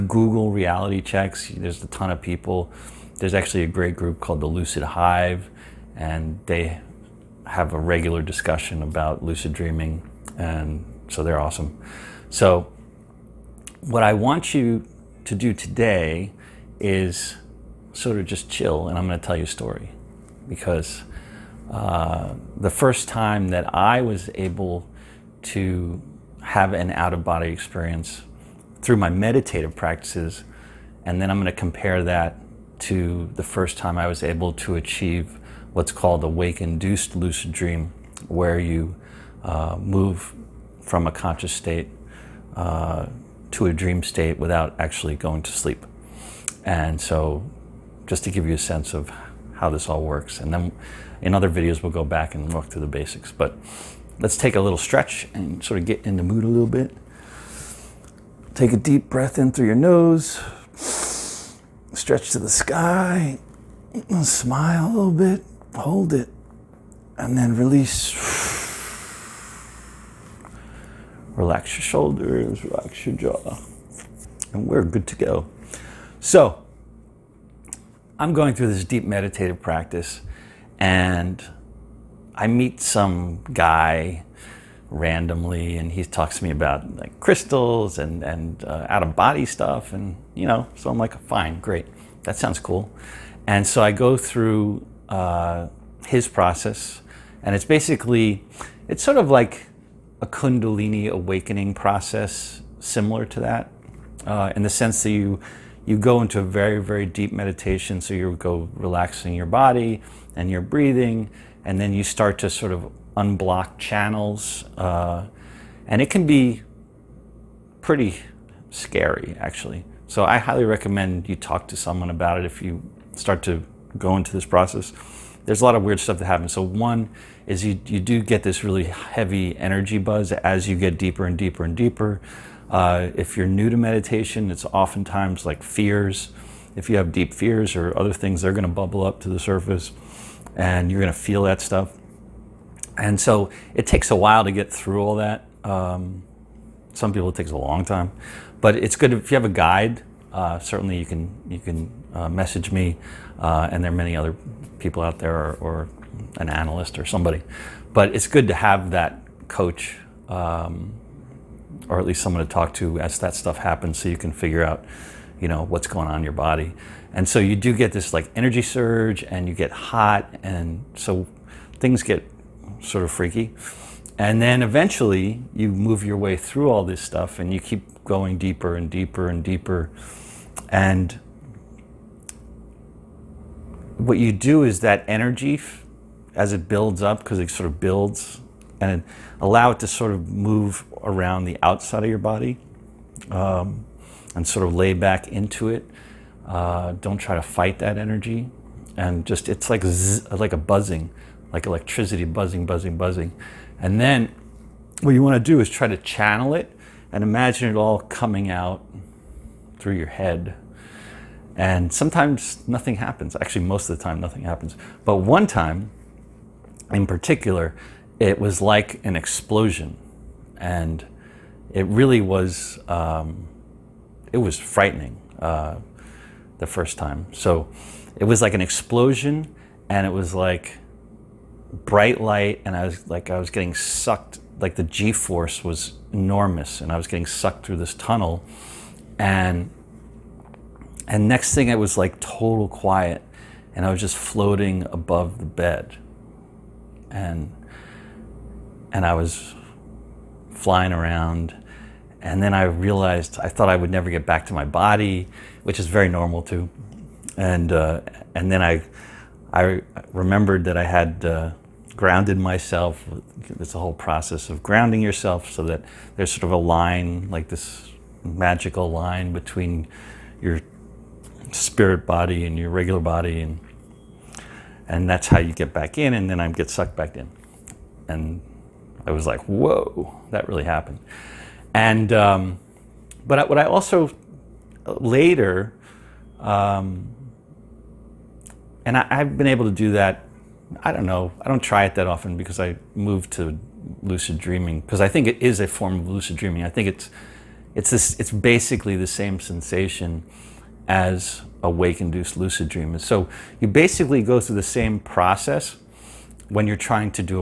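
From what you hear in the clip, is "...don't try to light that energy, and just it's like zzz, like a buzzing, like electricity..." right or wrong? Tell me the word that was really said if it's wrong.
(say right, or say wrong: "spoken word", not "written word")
wrong: "fight", not "light".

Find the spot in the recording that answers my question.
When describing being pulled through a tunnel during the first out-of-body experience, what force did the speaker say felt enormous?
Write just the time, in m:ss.
3:54.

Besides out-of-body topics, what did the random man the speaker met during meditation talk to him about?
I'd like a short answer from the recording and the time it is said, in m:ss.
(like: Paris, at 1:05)
crystals, at 1:27.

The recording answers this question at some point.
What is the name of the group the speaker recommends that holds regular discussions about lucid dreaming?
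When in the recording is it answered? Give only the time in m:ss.
0:04.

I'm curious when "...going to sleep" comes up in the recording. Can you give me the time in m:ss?
0:45.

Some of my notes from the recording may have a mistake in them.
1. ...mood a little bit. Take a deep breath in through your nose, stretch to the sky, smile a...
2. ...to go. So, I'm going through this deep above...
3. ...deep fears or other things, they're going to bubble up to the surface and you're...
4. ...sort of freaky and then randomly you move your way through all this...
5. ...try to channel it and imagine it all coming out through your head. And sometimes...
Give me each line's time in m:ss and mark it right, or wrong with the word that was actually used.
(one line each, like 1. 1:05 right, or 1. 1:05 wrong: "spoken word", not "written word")
1. 0:56 right
2. 1:15 wrong: "meditative", not "above"
3. 2:17 right
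4. 2:52 wrong: "eventually", not "randomly"
5. 3:25 right.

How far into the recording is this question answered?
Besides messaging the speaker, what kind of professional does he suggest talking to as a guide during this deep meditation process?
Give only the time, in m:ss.
2:36.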